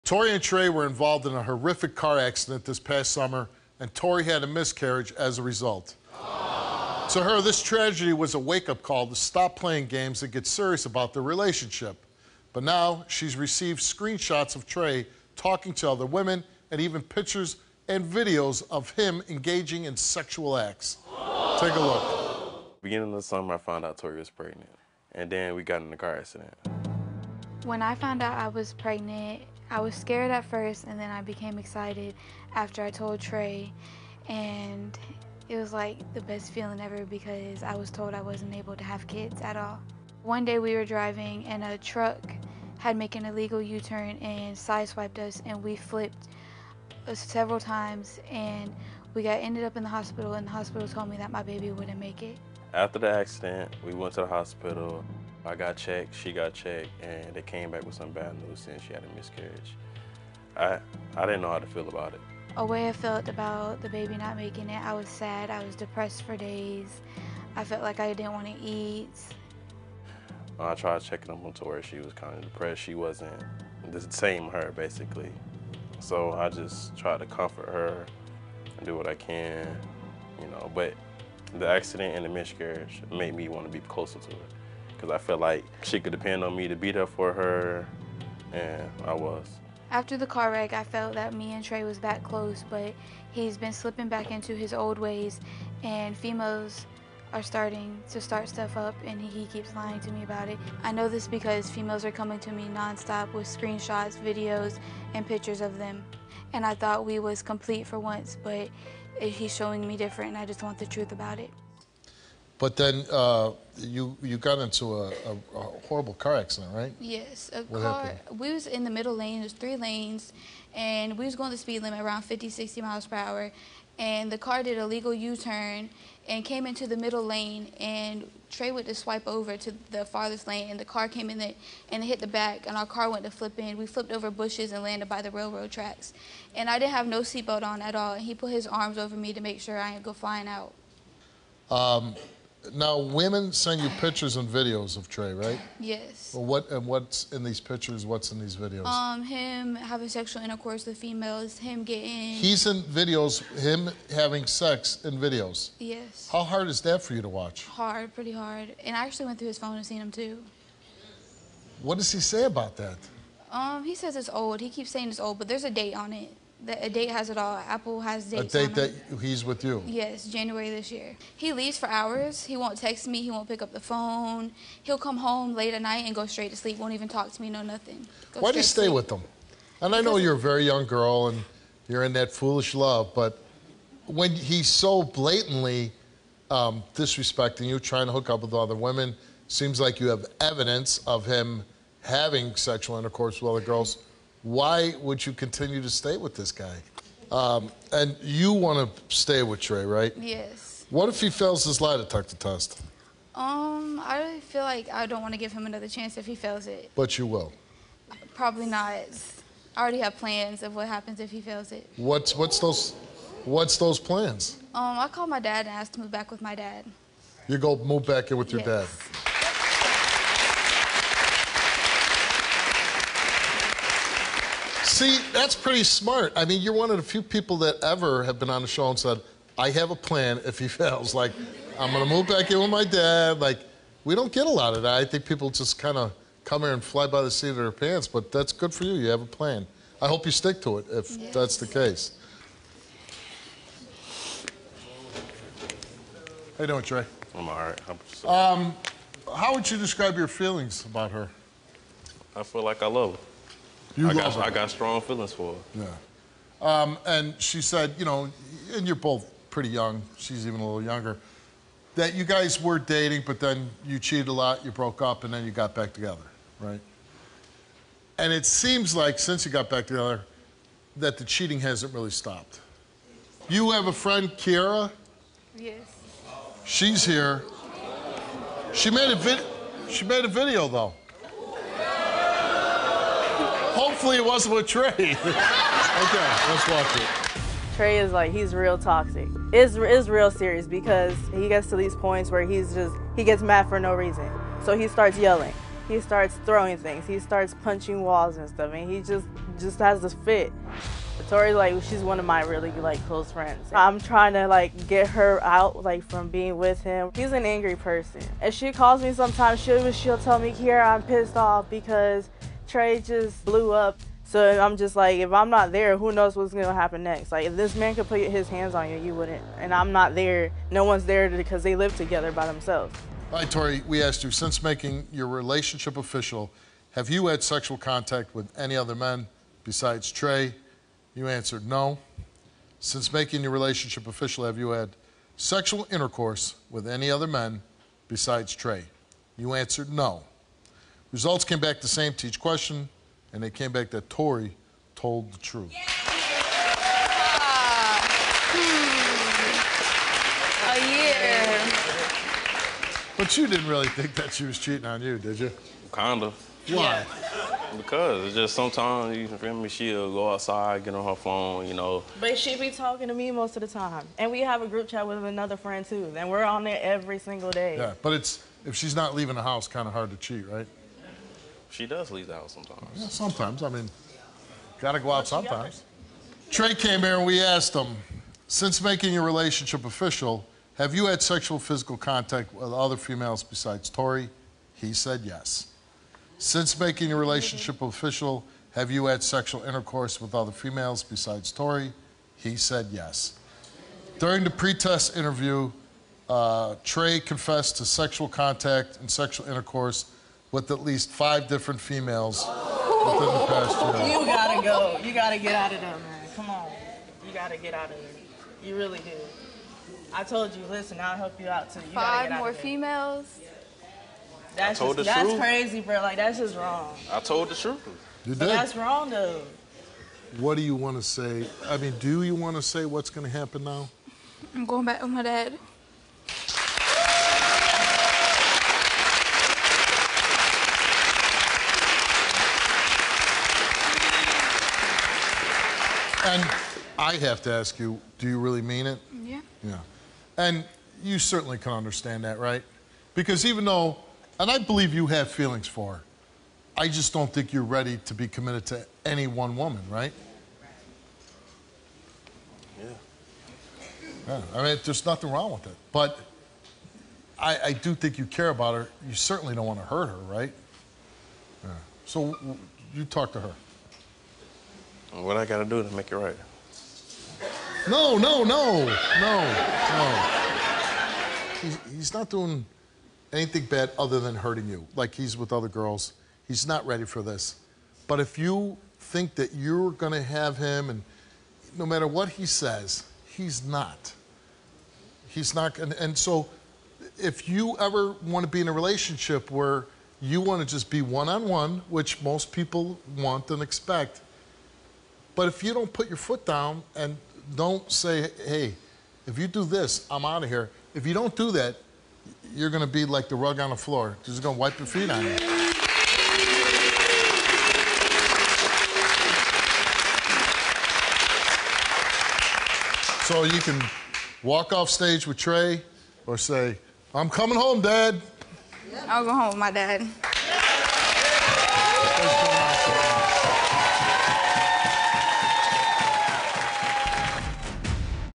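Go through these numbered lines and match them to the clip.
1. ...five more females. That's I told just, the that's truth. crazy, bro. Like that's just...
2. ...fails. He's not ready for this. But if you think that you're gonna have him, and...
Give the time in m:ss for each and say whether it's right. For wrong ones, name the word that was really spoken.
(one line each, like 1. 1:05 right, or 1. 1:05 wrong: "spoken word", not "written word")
1. 6:51 right
2. 7:55 wrong: "girls", not "fails".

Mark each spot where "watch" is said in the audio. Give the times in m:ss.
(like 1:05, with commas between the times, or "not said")
2:37, 4:46.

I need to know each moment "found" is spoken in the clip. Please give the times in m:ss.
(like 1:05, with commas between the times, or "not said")
0:23, 0:27.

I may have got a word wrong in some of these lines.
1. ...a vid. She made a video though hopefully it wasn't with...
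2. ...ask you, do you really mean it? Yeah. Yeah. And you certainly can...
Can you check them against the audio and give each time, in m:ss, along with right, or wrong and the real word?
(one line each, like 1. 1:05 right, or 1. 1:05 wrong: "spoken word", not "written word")
1. 4:39 right
2. 7:17 right.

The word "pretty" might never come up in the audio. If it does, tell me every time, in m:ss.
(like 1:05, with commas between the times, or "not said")
2:38, 3:45, 4:19.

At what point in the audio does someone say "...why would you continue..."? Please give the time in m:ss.
3:14.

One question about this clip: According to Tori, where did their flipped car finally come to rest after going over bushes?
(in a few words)
By the railroad tracks.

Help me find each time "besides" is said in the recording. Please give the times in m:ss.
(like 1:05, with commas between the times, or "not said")
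5:29, 5:38, 6:23, 6:31.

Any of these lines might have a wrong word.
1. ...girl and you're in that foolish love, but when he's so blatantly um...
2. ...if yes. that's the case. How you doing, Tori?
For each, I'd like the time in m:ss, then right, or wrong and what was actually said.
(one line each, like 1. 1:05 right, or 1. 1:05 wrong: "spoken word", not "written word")
1. 3:00 right
2. 4:00 wrong: "Trey", not "Tori".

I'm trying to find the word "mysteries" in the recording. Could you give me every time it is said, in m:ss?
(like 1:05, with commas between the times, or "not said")
not said.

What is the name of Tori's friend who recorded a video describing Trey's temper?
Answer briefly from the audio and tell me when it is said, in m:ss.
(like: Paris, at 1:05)
Kiara, at 4:34.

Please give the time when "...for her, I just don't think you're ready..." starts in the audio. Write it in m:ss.
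7:25.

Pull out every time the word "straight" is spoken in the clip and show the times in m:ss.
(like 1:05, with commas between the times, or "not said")
2:56.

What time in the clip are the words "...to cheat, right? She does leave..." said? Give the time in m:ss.
6:10.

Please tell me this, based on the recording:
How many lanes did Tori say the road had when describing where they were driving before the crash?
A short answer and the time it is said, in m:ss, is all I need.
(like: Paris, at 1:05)
3, at 1:59.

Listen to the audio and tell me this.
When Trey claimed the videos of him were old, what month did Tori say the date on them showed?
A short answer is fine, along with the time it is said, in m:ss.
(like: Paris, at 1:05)
January, at 2:50.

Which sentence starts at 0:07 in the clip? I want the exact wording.
So To her, this tragedy was a wake up call to stop playing games and get serious about their relationship.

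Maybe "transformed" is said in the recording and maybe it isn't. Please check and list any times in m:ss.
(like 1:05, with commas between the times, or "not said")
not said.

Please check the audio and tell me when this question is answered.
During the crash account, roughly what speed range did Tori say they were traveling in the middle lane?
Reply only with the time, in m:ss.
2:02.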